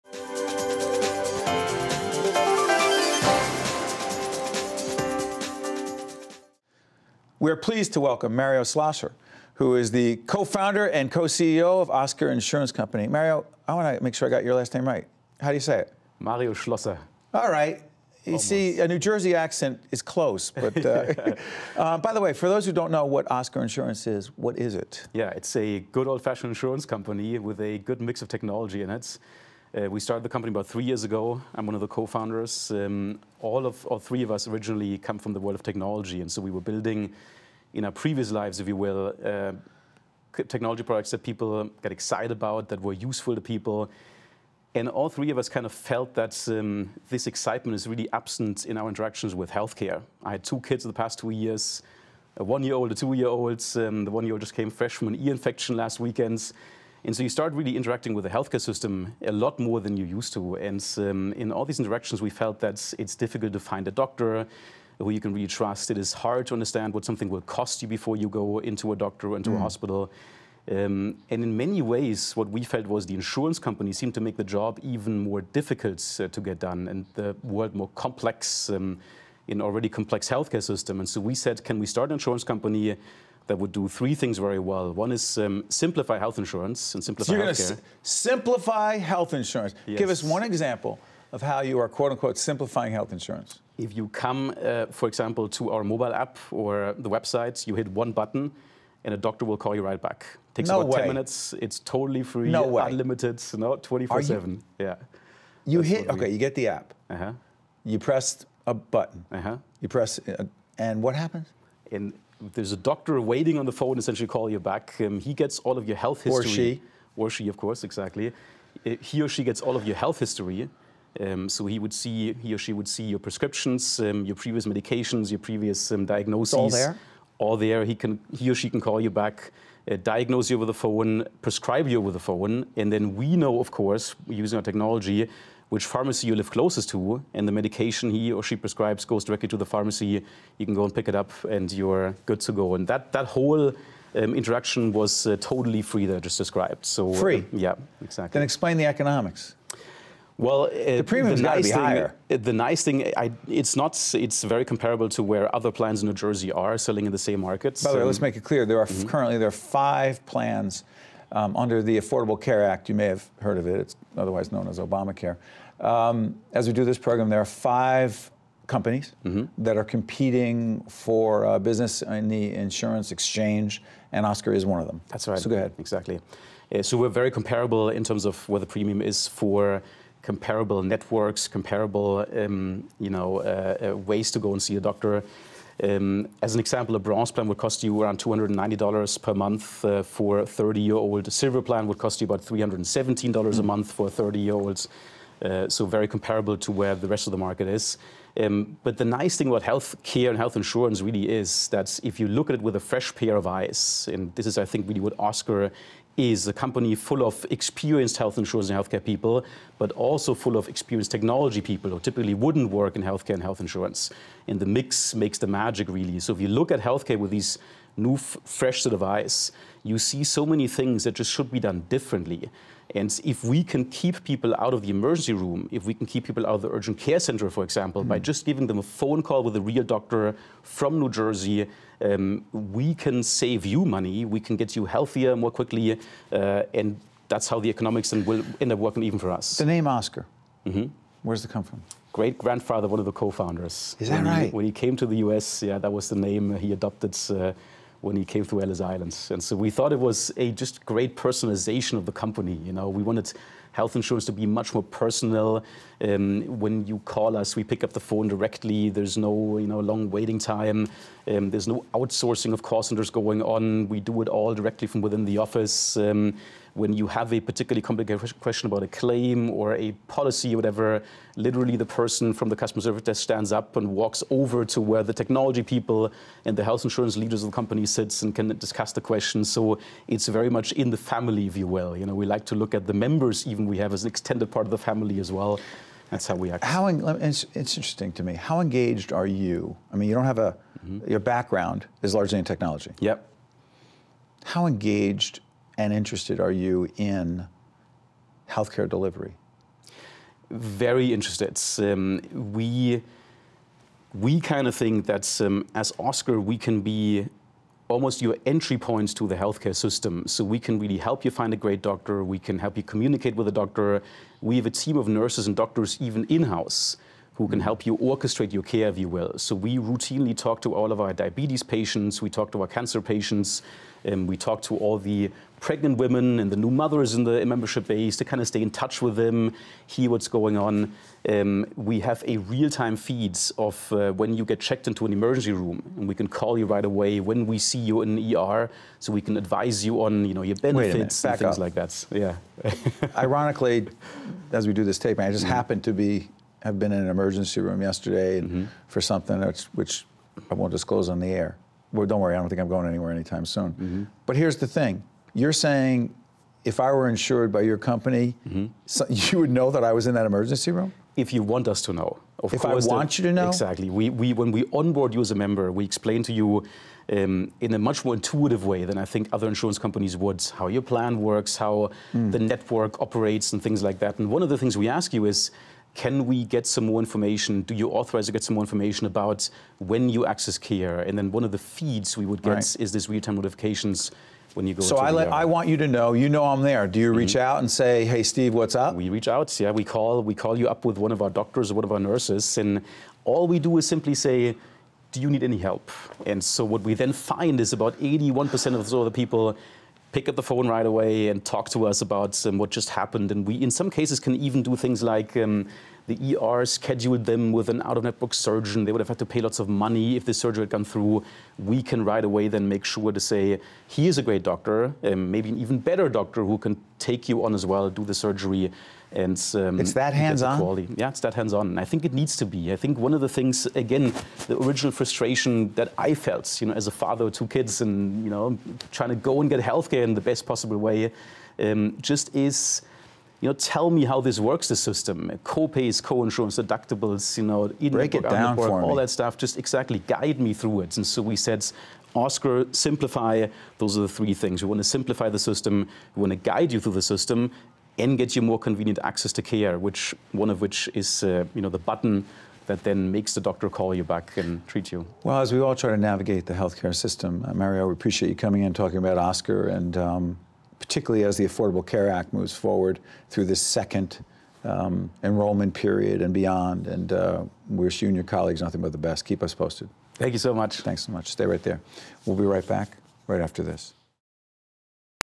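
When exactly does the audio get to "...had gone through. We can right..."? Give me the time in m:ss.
6:50.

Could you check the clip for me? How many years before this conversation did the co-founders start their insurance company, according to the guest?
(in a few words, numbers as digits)
3 years.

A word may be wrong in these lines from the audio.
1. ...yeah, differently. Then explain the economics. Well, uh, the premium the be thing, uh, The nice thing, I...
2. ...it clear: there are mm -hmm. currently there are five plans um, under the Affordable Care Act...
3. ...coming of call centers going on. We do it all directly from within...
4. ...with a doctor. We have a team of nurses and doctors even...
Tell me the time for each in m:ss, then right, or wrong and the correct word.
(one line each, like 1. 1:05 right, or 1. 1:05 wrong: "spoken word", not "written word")
1. 2:27 wrong: "exactly", not "differently"
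2. 2:38 right
3. 4:21 wrong: "outsourcing", not "coming"
4. 5:13 right.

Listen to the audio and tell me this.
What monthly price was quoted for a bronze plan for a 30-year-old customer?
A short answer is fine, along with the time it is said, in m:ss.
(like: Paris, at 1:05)
$290, at 3:08.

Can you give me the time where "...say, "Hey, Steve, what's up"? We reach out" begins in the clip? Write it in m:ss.
6:27.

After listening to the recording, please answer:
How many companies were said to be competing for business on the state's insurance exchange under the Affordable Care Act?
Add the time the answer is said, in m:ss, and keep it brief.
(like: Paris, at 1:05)
5, at 2:47.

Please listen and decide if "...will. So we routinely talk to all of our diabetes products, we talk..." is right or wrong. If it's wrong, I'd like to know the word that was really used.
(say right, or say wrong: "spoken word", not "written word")
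wrong: "patients", not "products".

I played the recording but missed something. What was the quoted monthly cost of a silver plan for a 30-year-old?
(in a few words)
$317.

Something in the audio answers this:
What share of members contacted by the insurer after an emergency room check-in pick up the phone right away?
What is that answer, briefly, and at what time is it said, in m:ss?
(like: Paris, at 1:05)
81%, at 6:38.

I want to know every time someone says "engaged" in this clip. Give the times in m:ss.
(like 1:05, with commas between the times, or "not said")
4:48, 4:54.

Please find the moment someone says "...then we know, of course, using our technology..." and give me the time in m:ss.
2:12.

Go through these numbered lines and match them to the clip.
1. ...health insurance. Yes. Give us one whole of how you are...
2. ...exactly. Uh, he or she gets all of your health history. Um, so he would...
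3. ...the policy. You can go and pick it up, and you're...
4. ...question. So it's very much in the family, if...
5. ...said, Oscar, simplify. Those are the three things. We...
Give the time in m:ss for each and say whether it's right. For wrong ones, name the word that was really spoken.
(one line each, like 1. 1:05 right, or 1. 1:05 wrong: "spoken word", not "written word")
1. 1:29 wrong: "example", not "whole"
2. 1:57 right
3. 2:19 wrong: "pharmacy", not "policy"
4. 4:39 right
5. 7:21 right.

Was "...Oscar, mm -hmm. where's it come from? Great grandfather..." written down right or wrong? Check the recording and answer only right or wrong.
right.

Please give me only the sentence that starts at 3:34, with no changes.
And the mix makes the magic, really.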